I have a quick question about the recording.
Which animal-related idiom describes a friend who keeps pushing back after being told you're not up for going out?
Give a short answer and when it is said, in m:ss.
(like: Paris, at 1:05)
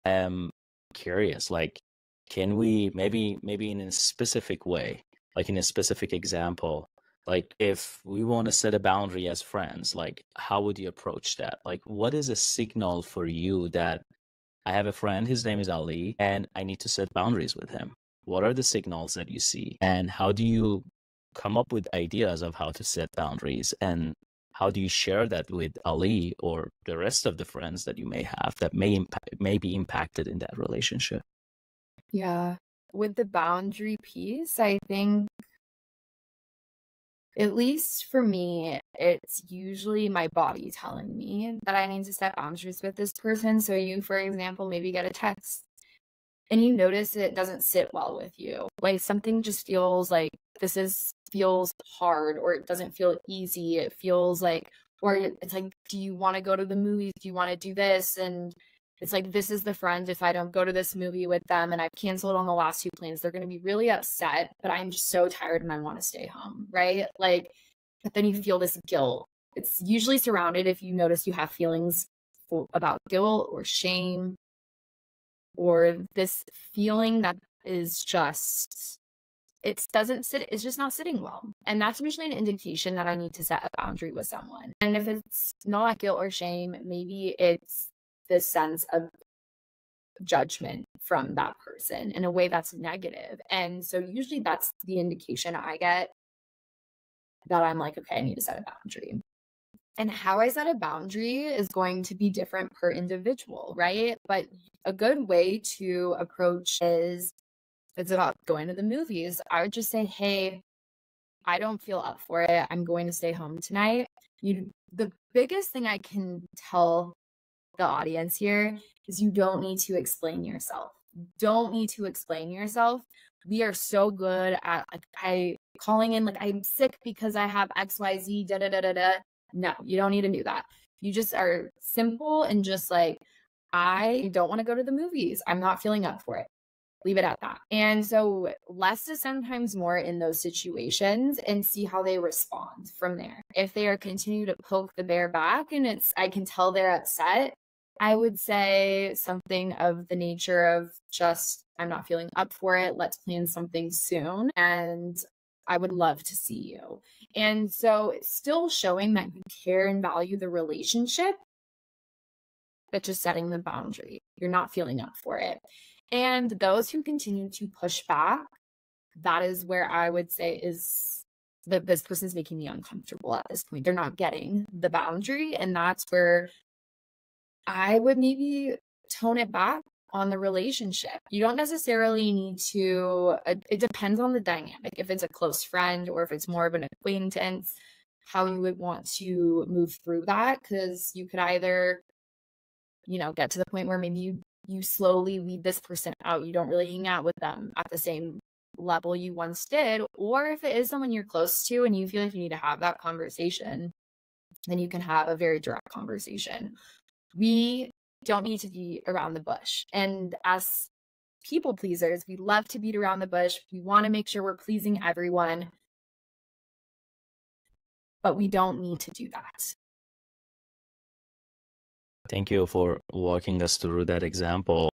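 poke the bear, at 2:24.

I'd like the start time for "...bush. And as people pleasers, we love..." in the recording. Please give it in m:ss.
3:29.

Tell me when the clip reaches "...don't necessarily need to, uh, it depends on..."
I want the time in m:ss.
3:01.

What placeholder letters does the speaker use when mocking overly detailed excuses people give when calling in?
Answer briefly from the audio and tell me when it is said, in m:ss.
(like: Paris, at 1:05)
XYZ, at 2:07.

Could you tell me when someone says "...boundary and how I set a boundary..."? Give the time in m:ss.
1:38.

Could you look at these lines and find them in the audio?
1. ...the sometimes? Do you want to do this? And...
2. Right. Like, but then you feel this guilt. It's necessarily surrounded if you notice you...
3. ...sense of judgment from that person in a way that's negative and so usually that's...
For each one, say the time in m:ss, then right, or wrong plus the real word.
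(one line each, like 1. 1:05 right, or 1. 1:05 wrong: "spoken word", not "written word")
1. 0:56 wrong: "movies", not "sometimes"
2. 1:06 wrong: "usually", not "necessarily"
3. 1:28 right.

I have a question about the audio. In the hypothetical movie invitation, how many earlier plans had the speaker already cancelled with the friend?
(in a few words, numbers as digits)
2.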